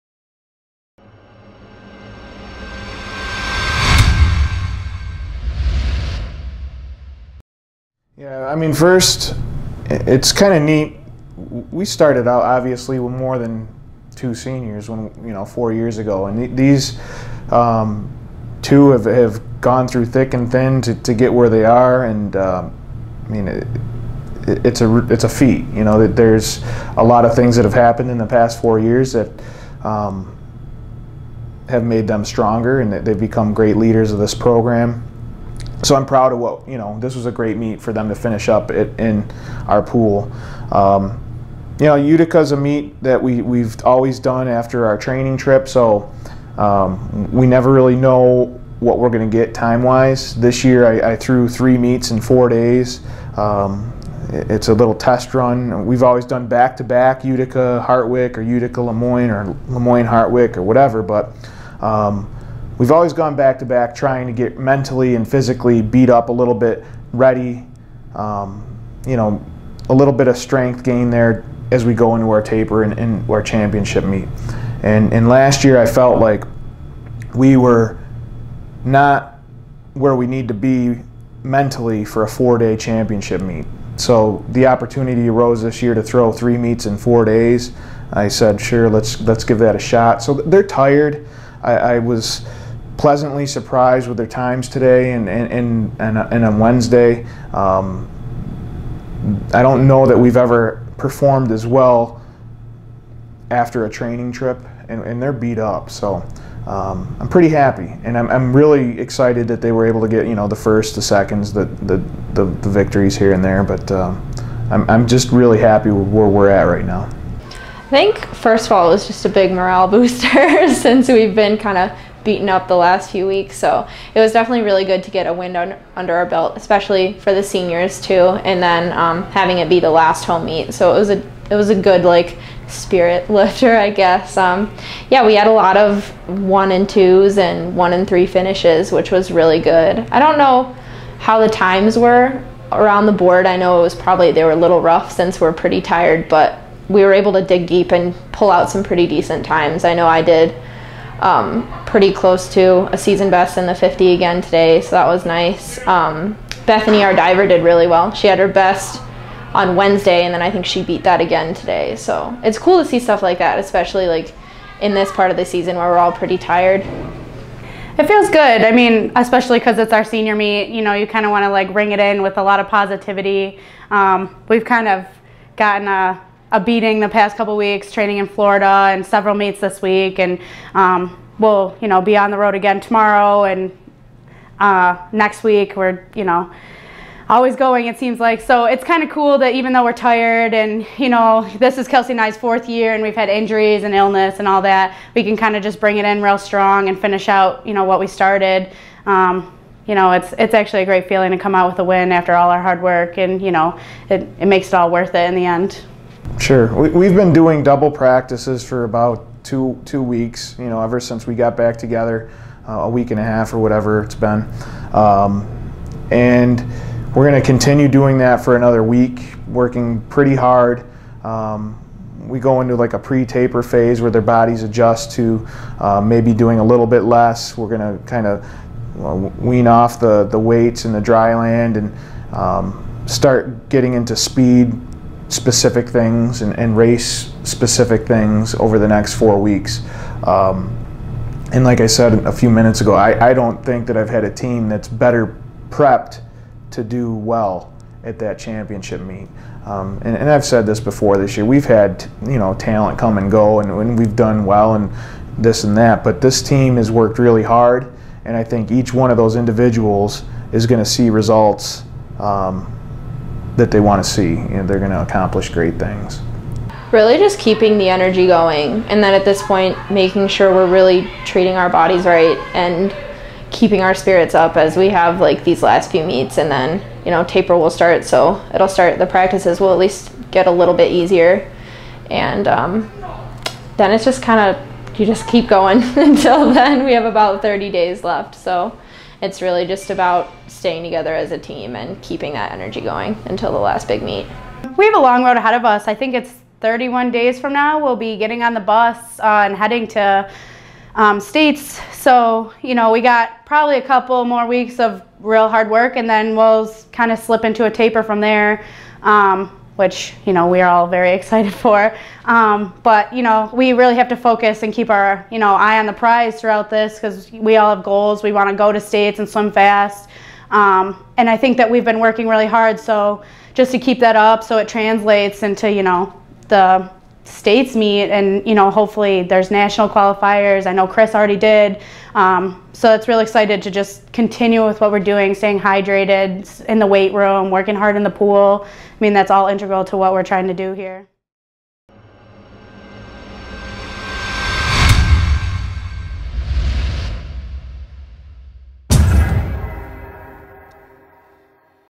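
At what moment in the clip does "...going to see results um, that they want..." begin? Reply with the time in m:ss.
4:20.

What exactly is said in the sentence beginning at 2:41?
So it's cool to see stuff like that, especially like in this part of the season where we're all pretty tired.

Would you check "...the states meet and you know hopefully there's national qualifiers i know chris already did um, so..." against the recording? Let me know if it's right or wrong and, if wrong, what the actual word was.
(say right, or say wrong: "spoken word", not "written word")
right.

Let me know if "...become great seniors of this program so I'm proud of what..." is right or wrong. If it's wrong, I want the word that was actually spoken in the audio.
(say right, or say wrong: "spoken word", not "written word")
wrong: "leaders", not "seniors".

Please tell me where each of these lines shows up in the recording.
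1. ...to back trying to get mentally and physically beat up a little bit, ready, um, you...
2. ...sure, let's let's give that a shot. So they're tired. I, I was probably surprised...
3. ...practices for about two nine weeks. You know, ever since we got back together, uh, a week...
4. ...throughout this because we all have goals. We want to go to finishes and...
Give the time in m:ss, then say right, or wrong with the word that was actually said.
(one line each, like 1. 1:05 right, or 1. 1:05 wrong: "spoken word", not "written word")
1. 1:03 right
2. 1:28 wrong: "pleasantly", not "probably"
3. 3:27 wrong: "two", not "nine"
4. 5:16 wrong: "states", not "finishes".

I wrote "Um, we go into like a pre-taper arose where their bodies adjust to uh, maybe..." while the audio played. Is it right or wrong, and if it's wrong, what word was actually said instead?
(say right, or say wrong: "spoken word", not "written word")
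wrong: "phase", not "arose".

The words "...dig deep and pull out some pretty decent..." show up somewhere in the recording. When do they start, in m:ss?
2:27.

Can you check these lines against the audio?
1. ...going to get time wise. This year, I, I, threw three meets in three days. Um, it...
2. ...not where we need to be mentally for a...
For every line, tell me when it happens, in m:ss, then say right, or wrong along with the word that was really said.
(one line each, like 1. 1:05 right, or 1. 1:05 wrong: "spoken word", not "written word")
1. 0:49 wrong: "four", not "three"
2. 1:18 right.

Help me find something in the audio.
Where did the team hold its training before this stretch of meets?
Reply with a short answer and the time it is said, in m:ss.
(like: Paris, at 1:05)
Florida, at 2:58.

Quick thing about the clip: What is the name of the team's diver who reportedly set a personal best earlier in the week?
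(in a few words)
Bethany.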